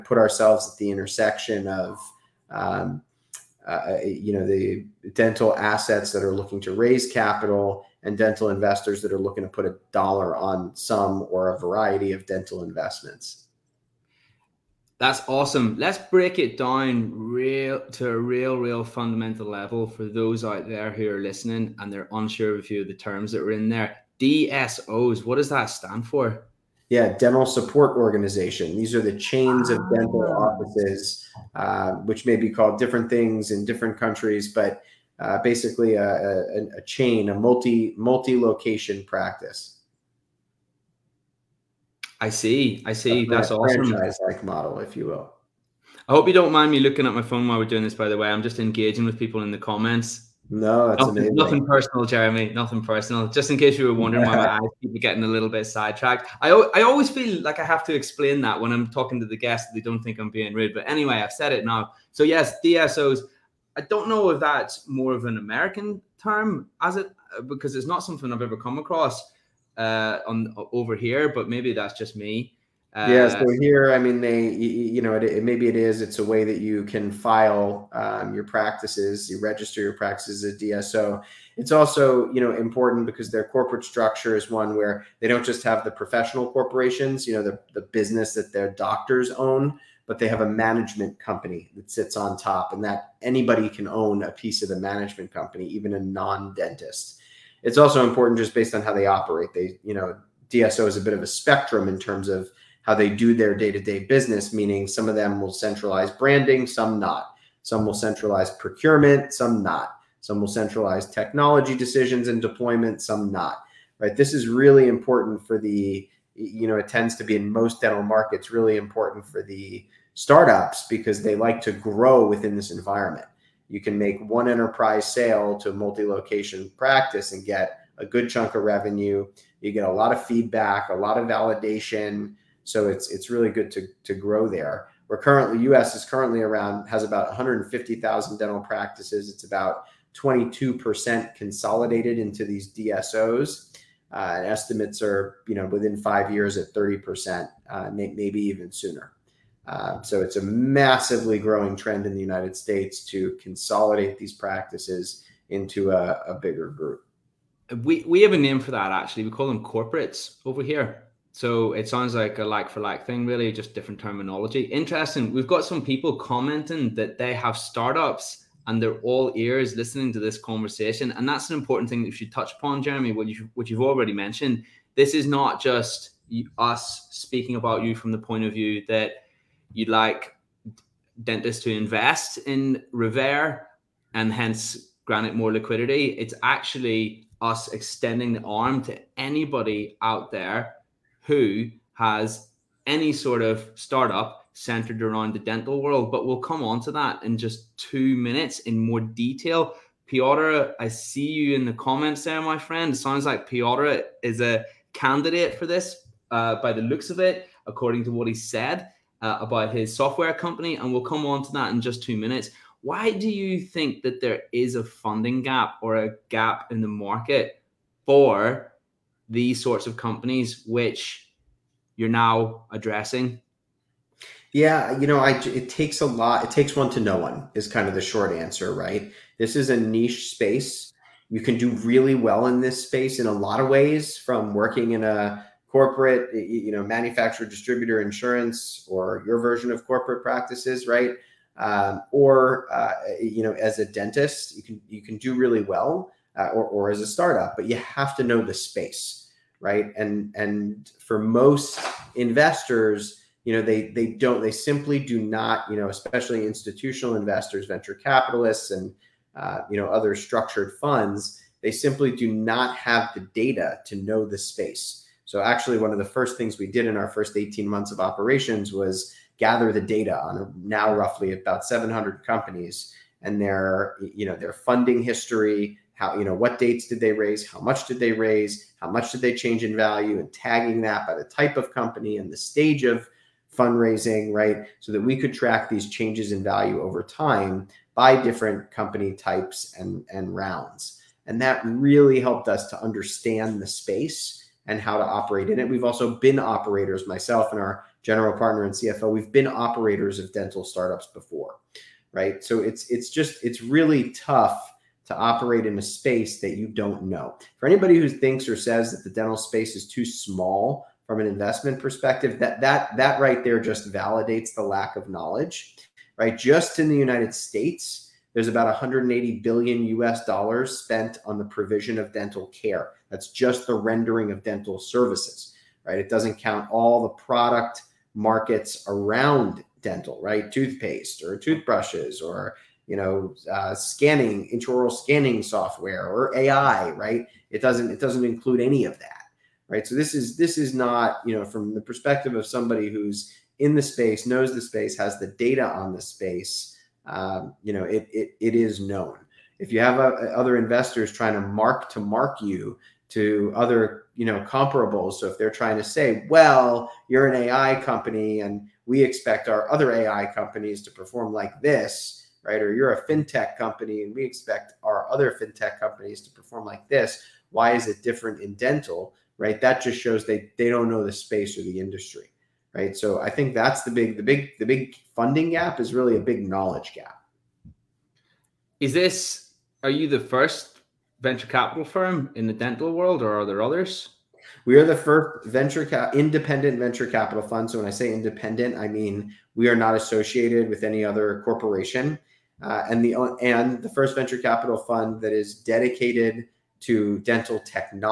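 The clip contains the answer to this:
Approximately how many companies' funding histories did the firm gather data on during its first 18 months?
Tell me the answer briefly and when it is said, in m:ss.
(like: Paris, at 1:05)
700, at 4:31.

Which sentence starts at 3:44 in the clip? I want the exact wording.
Yeah, you know, I, it takes a lot.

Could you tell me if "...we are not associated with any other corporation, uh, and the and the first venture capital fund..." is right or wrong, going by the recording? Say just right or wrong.
right.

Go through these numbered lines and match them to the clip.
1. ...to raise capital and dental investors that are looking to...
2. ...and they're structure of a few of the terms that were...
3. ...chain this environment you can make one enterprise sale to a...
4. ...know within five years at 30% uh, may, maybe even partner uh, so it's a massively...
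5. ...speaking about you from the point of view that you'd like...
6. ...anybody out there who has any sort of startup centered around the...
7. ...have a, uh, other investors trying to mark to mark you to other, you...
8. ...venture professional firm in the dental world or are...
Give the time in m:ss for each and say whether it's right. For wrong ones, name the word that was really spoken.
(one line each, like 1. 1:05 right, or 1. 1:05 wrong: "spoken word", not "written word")
1. 0:06 right
2. 0:21 wrong: "unsure", not "structure"
3. 2:02 wrong: "within", not "chain"
4. 2:25 wrong: "sooner", not "partner"
5. 2:57 right
6. 3:09 right
7. 5:49 right
8. 6:21 wrong: "capital", not "professional".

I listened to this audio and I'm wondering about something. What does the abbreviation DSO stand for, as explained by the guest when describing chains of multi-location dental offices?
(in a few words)
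dental support organization.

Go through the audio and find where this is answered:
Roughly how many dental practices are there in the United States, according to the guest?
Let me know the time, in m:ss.
2:17.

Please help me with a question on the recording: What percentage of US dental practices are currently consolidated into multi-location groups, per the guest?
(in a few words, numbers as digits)
22%.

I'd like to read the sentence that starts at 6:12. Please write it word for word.
So I think that's the big the big the big funding gap is really a big knowledge gap.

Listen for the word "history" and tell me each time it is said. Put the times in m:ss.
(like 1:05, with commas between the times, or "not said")
4:35.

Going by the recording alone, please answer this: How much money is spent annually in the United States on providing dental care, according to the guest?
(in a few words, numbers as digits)
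180 billion US dollars.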